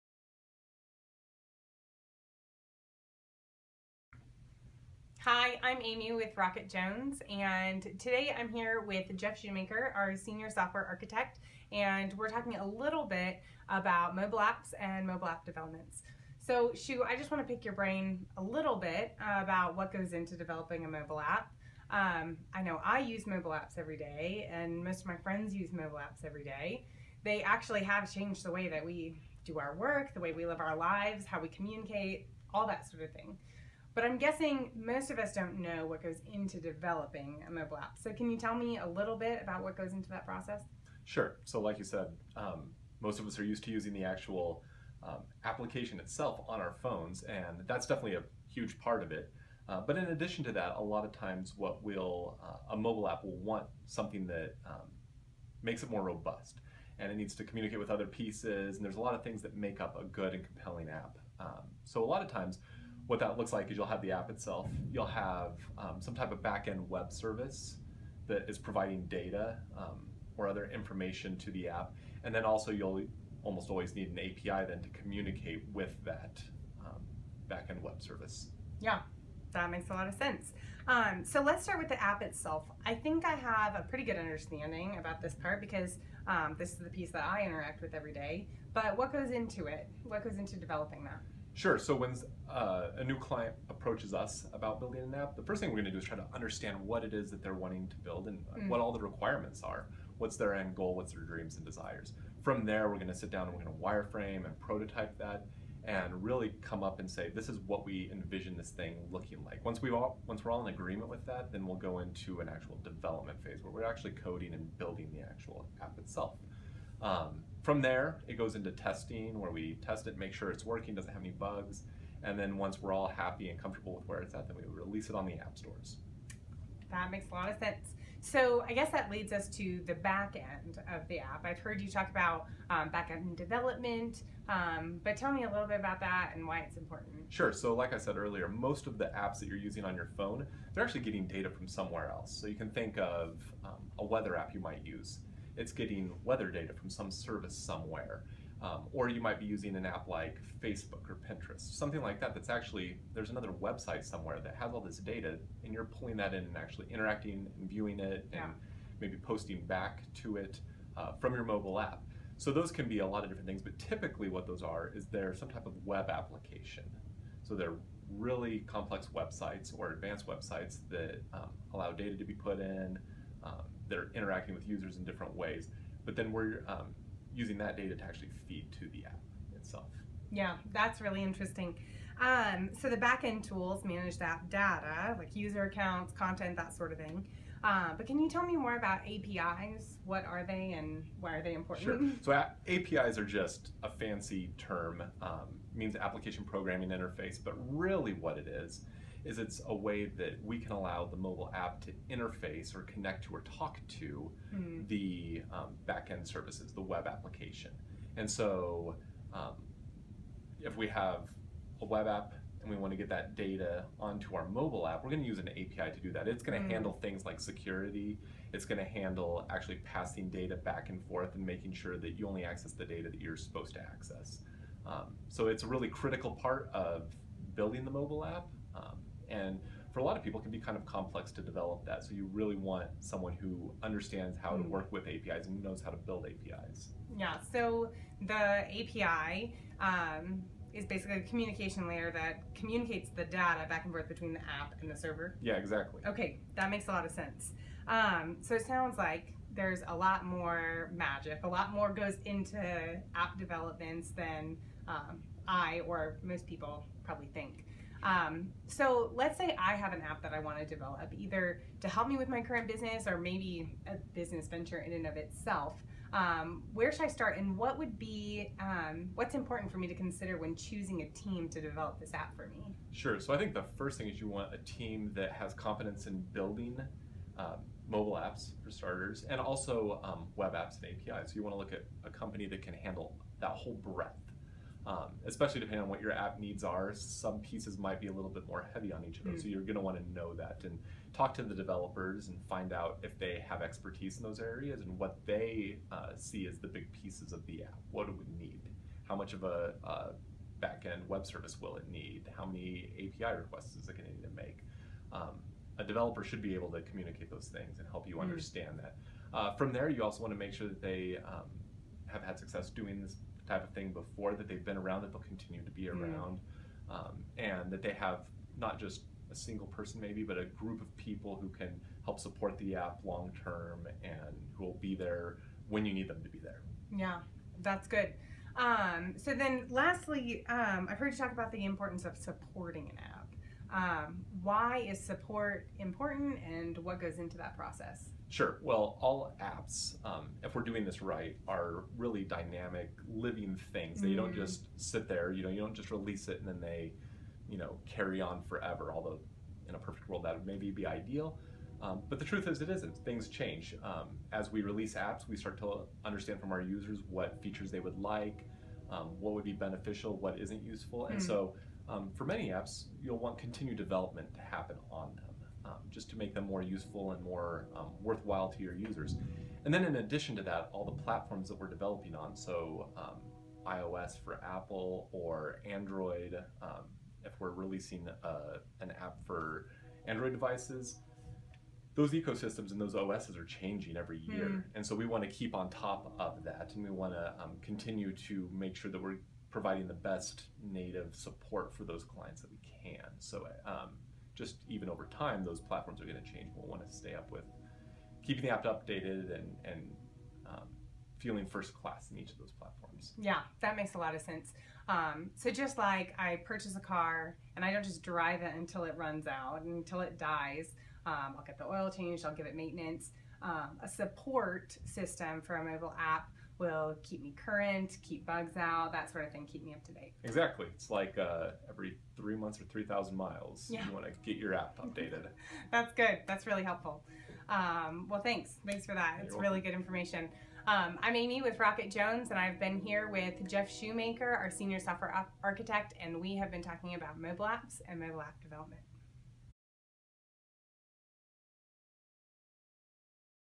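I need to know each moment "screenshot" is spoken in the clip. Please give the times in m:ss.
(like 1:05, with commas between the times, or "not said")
not said.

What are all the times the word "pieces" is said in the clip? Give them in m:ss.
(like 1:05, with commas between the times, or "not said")
0:58, 1:26, 4:47, 4:56.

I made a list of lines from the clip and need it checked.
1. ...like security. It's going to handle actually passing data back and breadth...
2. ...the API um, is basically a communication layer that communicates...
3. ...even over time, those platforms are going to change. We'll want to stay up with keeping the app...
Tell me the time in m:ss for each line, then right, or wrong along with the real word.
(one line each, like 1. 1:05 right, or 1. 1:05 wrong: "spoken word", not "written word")
1. 3:37 wrong: "forth", not "breadth"
2. 3:58 right
3. 6:34 right.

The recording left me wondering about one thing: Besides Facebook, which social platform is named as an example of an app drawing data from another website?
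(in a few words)
Pinterest.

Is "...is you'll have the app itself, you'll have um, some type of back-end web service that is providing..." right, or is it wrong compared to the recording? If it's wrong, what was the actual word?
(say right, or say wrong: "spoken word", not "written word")
right.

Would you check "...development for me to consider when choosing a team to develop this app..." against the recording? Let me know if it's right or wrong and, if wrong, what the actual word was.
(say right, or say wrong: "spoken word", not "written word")
wrong: "important", not "development".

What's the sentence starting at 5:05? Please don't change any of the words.
Um, a developer should be able to communicate those things and help you mm.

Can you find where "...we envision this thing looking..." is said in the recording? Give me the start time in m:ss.
1:47.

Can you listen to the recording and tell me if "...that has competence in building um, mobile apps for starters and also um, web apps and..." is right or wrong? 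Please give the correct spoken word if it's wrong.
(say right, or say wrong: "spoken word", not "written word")
right.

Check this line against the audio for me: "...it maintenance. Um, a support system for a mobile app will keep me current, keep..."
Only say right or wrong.
right.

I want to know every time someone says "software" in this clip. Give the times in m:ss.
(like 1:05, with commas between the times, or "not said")
0:10, 7:14.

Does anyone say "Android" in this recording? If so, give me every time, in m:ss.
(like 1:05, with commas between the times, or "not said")
6:15, 6:20.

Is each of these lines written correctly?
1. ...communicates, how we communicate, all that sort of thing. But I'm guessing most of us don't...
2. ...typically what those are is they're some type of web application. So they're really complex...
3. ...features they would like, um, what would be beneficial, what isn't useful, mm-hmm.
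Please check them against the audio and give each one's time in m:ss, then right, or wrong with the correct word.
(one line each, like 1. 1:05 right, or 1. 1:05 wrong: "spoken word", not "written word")
1. 0:30 wrong: "lives", not "communicates"
2. 2:43 right
3. 5:57 right.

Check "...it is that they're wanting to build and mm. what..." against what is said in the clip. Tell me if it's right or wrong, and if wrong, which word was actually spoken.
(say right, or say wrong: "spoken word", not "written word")
right.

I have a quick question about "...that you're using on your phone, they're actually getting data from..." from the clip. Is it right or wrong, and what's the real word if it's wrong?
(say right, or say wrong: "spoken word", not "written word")
right.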